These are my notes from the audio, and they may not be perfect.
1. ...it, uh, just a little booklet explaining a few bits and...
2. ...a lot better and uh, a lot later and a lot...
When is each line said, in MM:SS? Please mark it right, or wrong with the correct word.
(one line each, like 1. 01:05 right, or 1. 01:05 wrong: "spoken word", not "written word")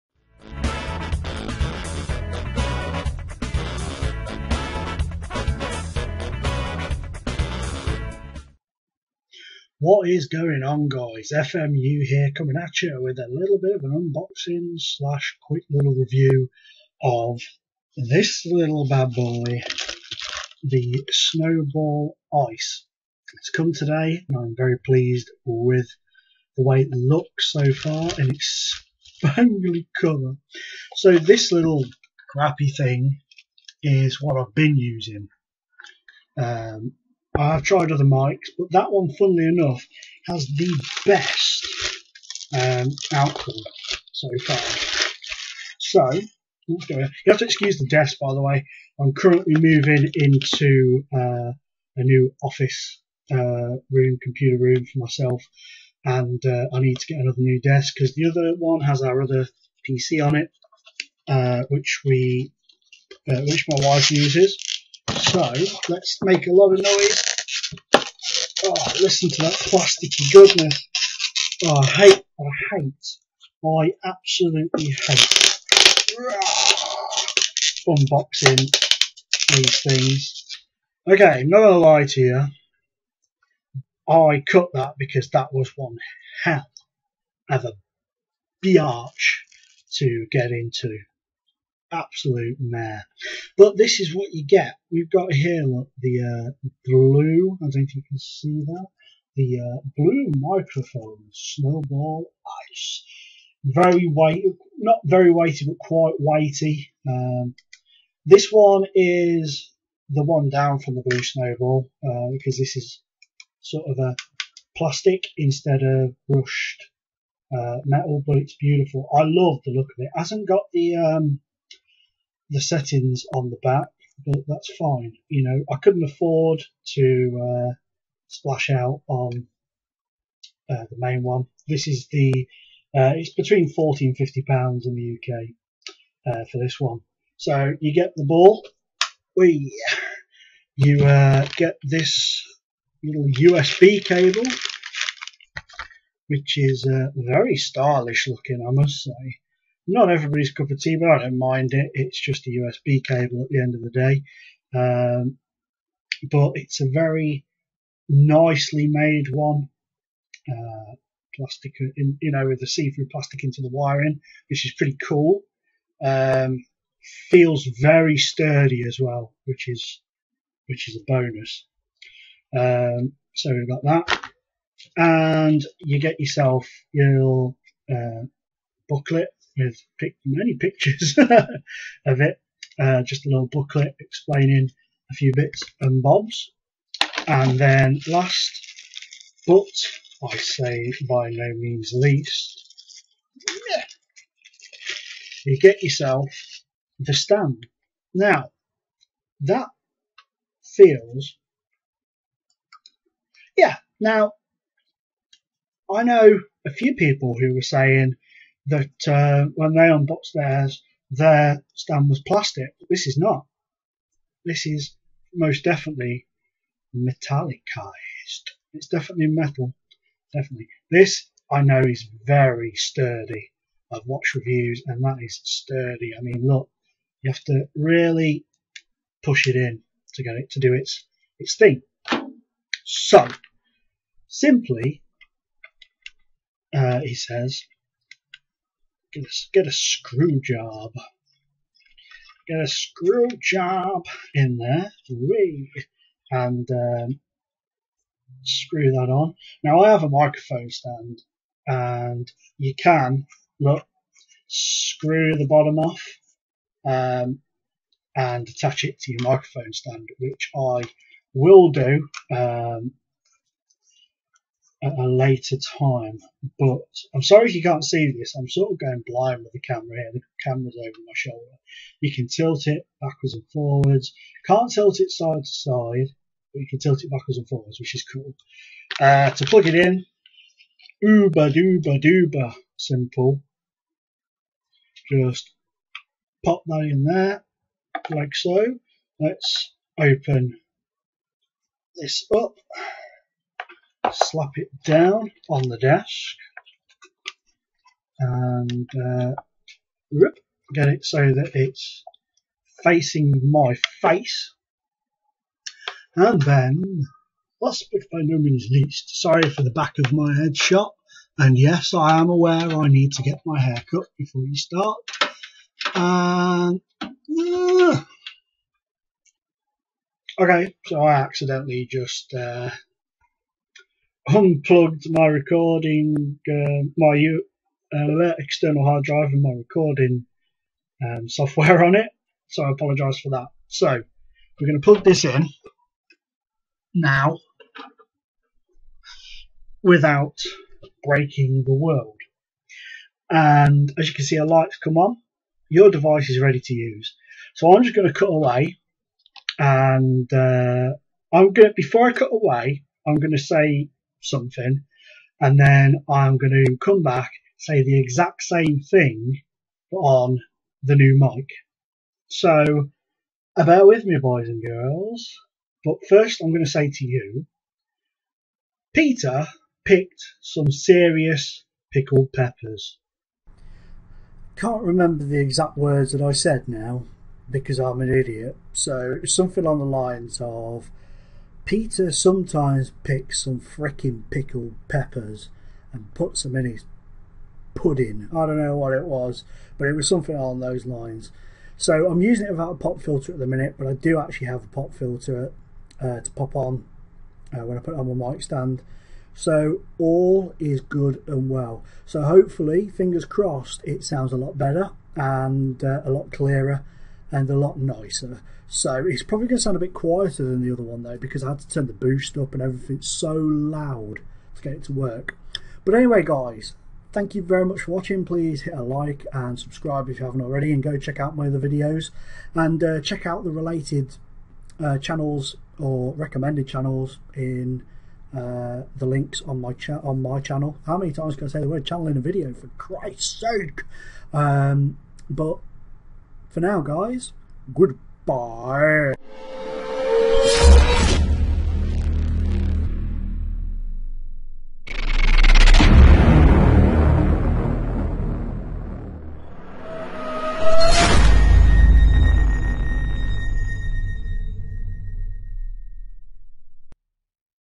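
1. 03:02 right
2. 06:44 wrong: "clearer", not "later".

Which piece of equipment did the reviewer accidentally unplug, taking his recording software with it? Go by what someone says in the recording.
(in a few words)
External hard drive.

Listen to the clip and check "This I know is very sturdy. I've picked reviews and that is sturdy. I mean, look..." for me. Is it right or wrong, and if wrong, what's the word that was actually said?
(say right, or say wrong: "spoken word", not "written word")
wrong: "watched", not "picked".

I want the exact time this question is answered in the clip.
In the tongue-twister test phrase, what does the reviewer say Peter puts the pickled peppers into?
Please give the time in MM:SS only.
06:26.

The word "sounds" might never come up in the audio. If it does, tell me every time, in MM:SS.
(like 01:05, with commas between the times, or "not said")
06:44, 06:49.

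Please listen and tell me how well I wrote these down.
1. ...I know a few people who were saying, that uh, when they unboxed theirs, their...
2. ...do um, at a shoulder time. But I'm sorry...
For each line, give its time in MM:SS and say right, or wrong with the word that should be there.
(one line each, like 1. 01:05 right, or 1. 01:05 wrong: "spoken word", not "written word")
1. 03:25 right
2. 04:21 wrong: "later", not "shoulder".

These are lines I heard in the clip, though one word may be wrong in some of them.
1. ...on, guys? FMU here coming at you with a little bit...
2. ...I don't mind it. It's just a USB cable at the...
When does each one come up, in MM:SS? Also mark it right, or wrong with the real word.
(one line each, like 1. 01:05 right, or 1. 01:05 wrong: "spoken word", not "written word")
1. 00:10 right
2. 02:31 right.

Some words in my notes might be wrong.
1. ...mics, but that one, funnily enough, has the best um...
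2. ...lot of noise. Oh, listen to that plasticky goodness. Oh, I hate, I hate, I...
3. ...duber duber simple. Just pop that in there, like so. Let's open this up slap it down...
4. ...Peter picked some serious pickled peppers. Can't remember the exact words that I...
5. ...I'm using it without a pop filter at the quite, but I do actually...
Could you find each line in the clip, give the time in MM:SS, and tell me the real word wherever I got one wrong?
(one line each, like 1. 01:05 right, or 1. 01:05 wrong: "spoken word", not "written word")
1. 00:38 right
2. 01:06 right
3. 04:41 right
4. 06:08 right
5. 06:32 wrong: "minute", not "quite".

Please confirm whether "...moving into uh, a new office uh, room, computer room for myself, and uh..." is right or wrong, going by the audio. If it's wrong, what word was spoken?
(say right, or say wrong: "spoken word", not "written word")
right.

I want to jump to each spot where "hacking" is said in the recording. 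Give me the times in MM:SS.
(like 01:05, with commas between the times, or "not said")
not said.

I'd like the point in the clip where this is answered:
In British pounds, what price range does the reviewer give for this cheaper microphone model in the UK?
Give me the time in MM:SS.
02:13.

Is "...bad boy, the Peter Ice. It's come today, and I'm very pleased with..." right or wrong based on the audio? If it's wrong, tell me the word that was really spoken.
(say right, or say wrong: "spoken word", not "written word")
wrong: "Snowball", not "Peter".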